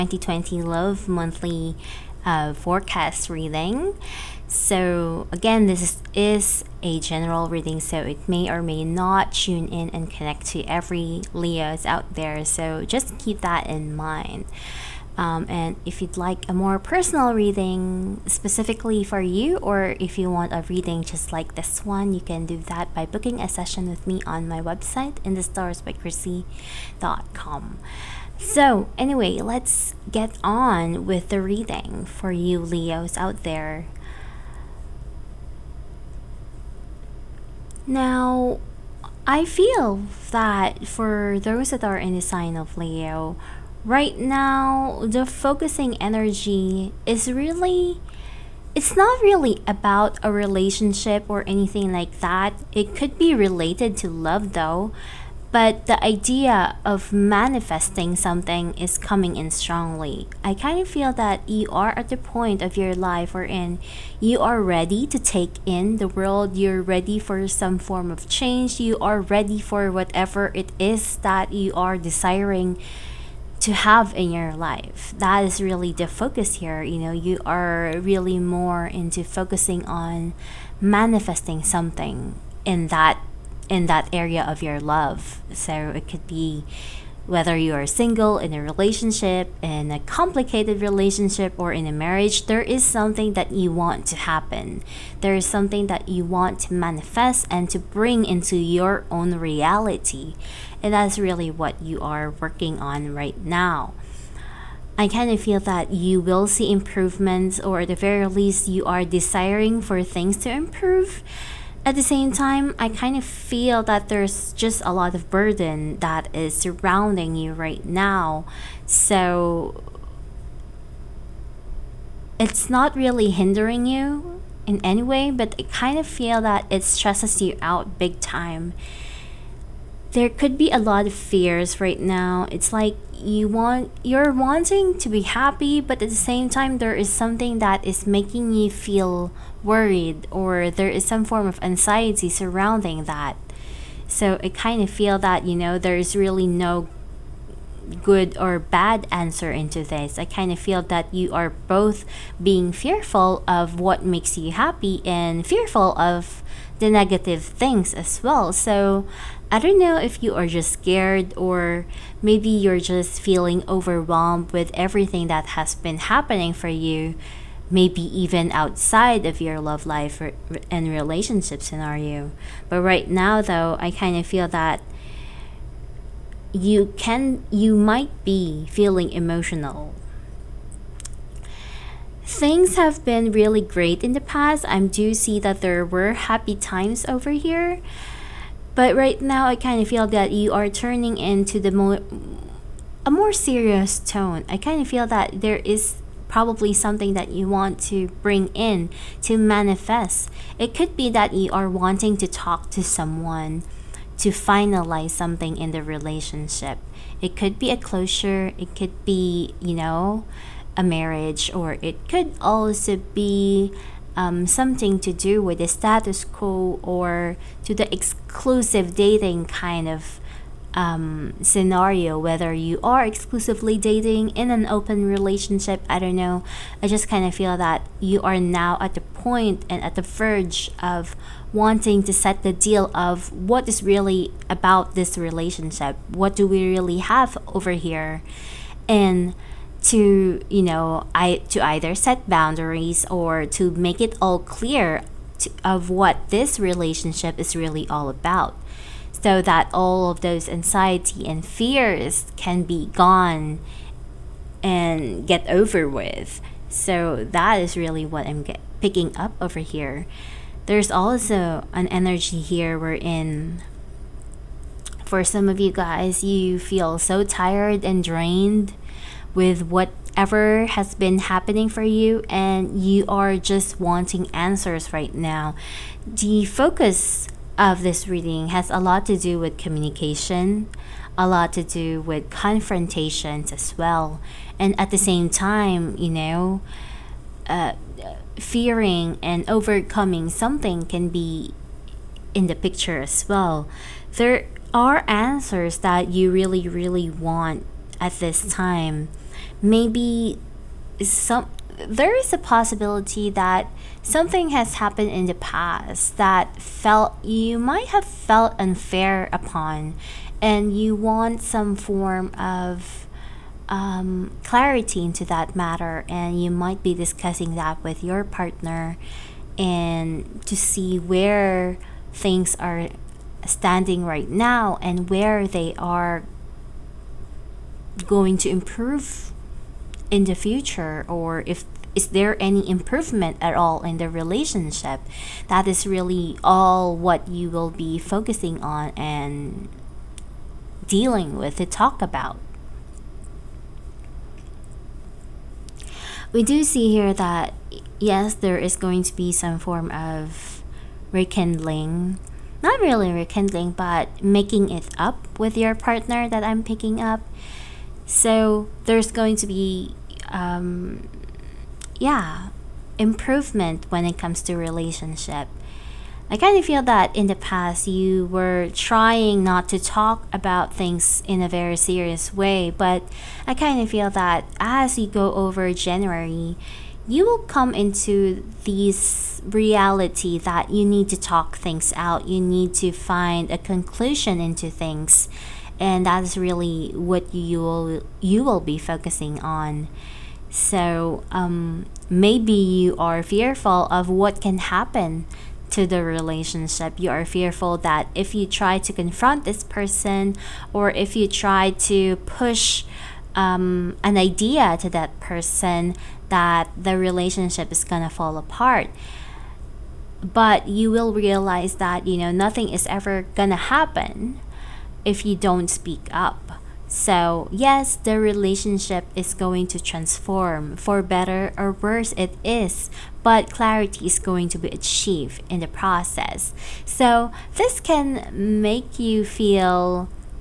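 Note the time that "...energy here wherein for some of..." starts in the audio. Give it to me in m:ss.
4:21.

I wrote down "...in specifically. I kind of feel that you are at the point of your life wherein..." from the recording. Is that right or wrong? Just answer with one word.
wrong.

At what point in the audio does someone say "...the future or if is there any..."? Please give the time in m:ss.
5:30.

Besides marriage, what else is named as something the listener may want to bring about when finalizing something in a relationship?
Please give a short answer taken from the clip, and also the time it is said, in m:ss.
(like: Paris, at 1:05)
A closure, at 3:27.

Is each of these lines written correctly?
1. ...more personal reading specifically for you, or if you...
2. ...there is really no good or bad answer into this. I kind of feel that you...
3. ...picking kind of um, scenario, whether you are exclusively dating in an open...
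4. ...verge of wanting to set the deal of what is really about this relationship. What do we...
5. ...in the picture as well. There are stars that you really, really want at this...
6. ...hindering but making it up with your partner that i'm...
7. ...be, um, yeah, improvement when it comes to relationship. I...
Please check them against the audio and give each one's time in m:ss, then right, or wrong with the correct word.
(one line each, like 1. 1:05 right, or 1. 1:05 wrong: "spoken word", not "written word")
1. 0:16 right
2. 2:25 right
3. 3:38 wrong: "dating", not "picking"
4. 3:50 right
5. 4:52 wrong: "answers", not "stars"
6. 5:53 wrong: "rekindling", not "hindering"
7. 5:59 right.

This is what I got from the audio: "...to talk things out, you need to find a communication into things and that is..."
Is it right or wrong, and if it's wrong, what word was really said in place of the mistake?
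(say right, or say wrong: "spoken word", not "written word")
wrong: "conclusion", not "communication".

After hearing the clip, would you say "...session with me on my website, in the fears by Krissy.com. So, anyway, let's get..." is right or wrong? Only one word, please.
wrong.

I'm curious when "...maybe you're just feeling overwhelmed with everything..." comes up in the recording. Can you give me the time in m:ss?
2:42.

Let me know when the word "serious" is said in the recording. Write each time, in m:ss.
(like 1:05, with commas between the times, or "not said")
3:13, 6:11.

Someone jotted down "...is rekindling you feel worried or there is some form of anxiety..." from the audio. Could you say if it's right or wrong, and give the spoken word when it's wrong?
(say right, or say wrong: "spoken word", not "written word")
wrong: "making", not "rekindling".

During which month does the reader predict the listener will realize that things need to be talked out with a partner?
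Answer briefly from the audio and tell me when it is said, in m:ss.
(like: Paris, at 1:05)
January, at 6:15.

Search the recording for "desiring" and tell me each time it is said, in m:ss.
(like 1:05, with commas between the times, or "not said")
1:11, 1:49.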